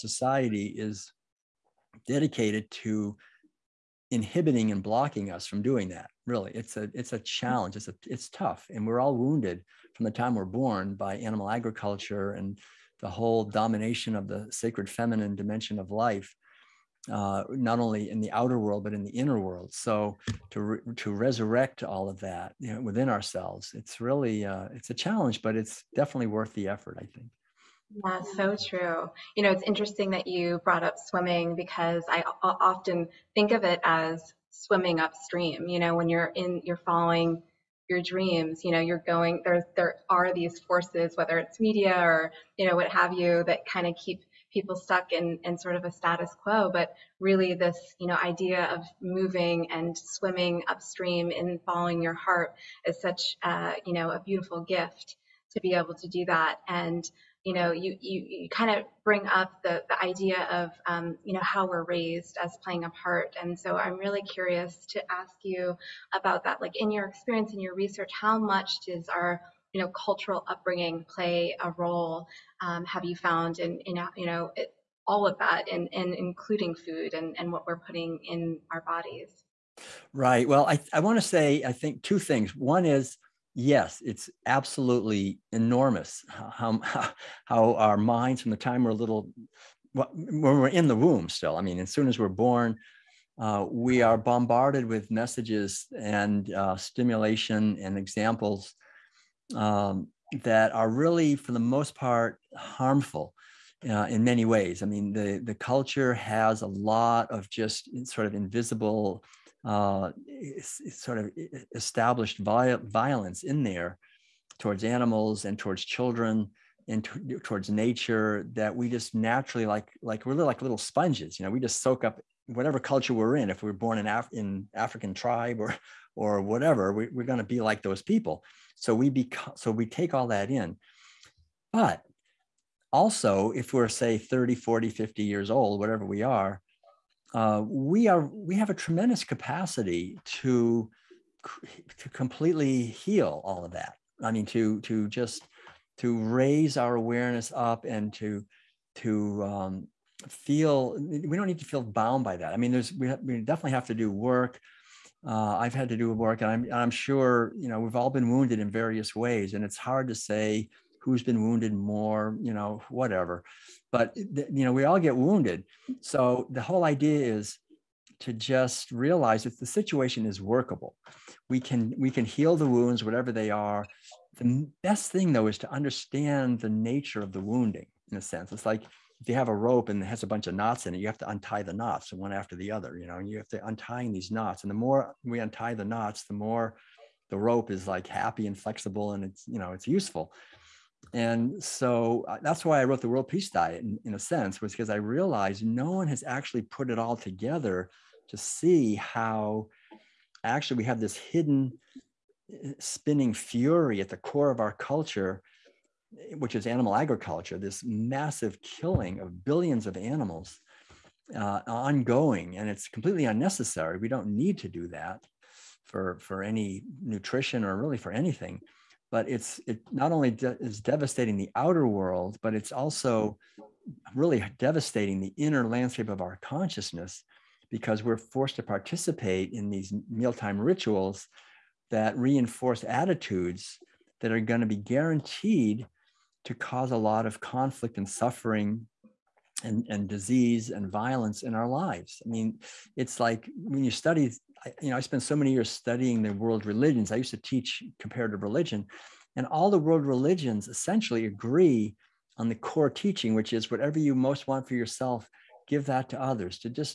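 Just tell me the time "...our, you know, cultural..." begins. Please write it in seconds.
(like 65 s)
69 s.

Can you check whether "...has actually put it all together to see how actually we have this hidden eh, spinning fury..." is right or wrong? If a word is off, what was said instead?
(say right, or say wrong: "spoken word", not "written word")
right.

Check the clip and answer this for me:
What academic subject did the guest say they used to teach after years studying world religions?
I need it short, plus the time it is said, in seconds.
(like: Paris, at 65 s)
Comparative religion, at 247 s.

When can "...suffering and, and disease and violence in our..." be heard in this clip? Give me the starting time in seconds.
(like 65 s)
238 s.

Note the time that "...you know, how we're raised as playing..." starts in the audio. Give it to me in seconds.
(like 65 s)
61 s.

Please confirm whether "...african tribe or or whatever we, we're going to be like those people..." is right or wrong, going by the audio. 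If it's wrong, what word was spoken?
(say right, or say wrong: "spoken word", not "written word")
right.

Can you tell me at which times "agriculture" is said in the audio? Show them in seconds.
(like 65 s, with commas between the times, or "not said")
11 s, 206 s.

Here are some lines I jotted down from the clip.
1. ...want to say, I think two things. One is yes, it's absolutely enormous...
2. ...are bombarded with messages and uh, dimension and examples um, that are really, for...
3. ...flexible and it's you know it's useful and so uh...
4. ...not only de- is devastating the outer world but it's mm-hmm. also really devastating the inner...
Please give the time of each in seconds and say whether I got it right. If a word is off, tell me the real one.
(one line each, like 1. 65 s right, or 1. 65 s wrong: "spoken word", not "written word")
1. 80 s right
2. 94 s wrong: "stimulation", not "dimension"
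3. 188 s right
4. 219 s right.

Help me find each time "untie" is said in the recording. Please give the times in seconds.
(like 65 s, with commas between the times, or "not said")
181 s, 185 s.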